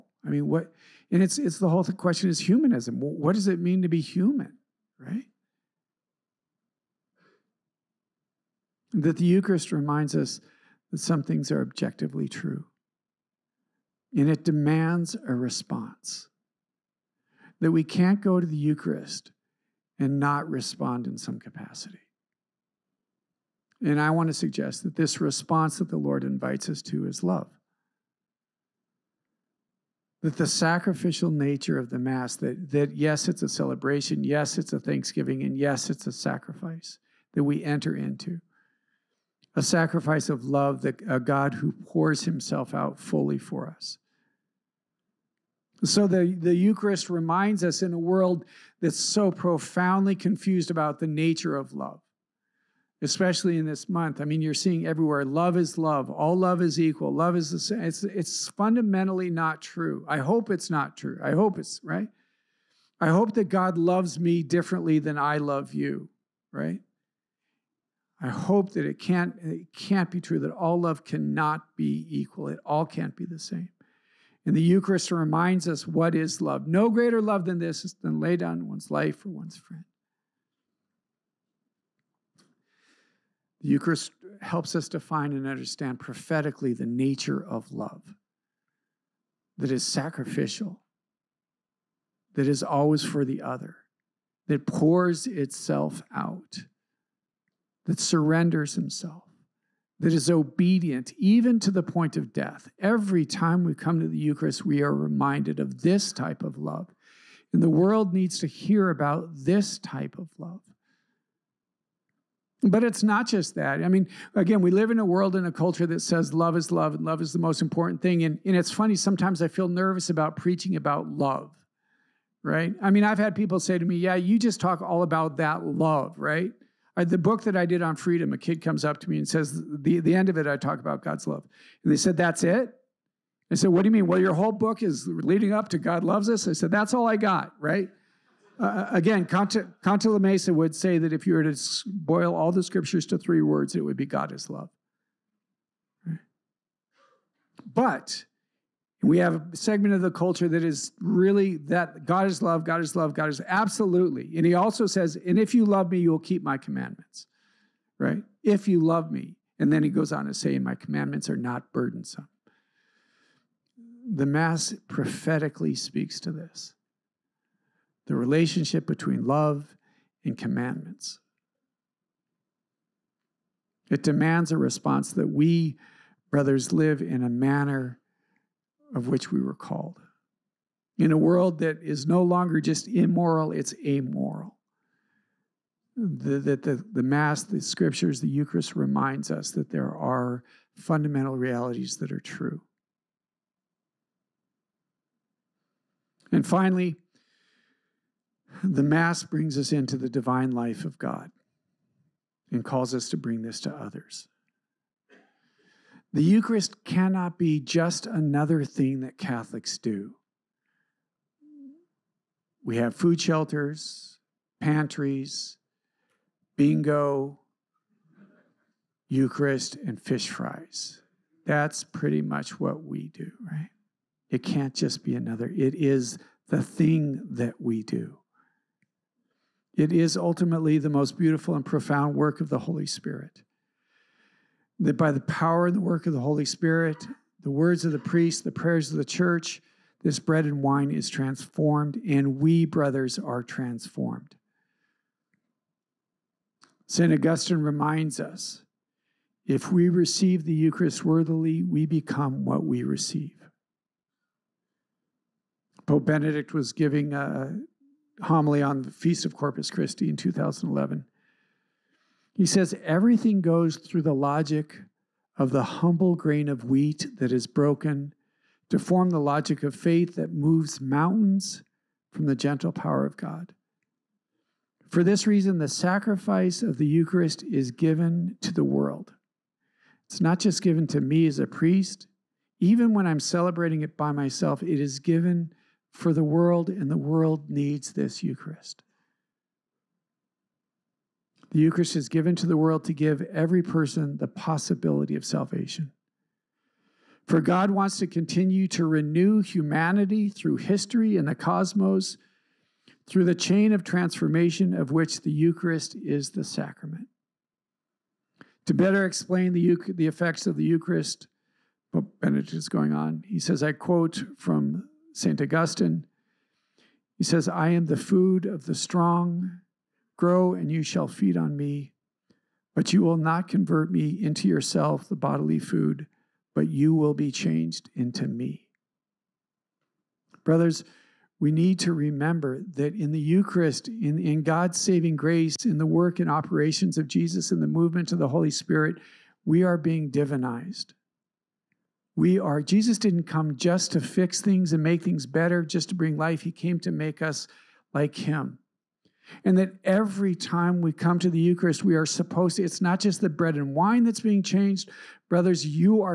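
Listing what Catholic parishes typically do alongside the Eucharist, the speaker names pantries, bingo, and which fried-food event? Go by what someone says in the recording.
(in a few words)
Fish fries.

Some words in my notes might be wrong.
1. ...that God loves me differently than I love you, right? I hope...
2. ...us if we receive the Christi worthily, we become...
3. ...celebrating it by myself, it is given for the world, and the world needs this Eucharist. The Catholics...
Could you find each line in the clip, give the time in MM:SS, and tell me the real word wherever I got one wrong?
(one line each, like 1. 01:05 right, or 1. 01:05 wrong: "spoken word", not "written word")
1. 01:03 right
2. 04:08 wrong: "Eucharist", not "Christi"
3. 04:43 wrong: "Eucharist", not "Catholics".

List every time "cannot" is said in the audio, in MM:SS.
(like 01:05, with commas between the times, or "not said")
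01:11, 03:26.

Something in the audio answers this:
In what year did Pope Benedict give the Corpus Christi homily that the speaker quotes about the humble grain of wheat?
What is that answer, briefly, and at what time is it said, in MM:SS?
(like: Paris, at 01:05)
2011, at 04:20.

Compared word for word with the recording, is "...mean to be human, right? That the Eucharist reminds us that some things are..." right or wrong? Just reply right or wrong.
right.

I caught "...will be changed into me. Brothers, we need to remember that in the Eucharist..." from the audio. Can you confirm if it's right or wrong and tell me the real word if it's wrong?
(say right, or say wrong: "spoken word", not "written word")
right.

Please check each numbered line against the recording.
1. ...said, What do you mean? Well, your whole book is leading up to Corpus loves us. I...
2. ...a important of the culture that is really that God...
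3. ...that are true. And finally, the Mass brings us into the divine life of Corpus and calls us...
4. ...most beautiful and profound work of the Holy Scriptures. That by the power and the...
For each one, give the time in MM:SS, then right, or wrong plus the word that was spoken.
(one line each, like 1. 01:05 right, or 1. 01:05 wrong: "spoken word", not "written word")
1. 02:13 wrong: "God", not "Corpus"
2. 02:29 wrong: "segment", not "important"
3. 03:11 wrong: "God", not "Corpus"
4. 03:50 wrong: "Spirit", not "Scriptures".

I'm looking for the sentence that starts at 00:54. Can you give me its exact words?
I mean, you're seeing everywhere love is love, all love is equal, love is the same.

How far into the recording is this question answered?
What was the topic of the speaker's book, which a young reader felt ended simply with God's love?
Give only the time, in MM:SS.
02:07.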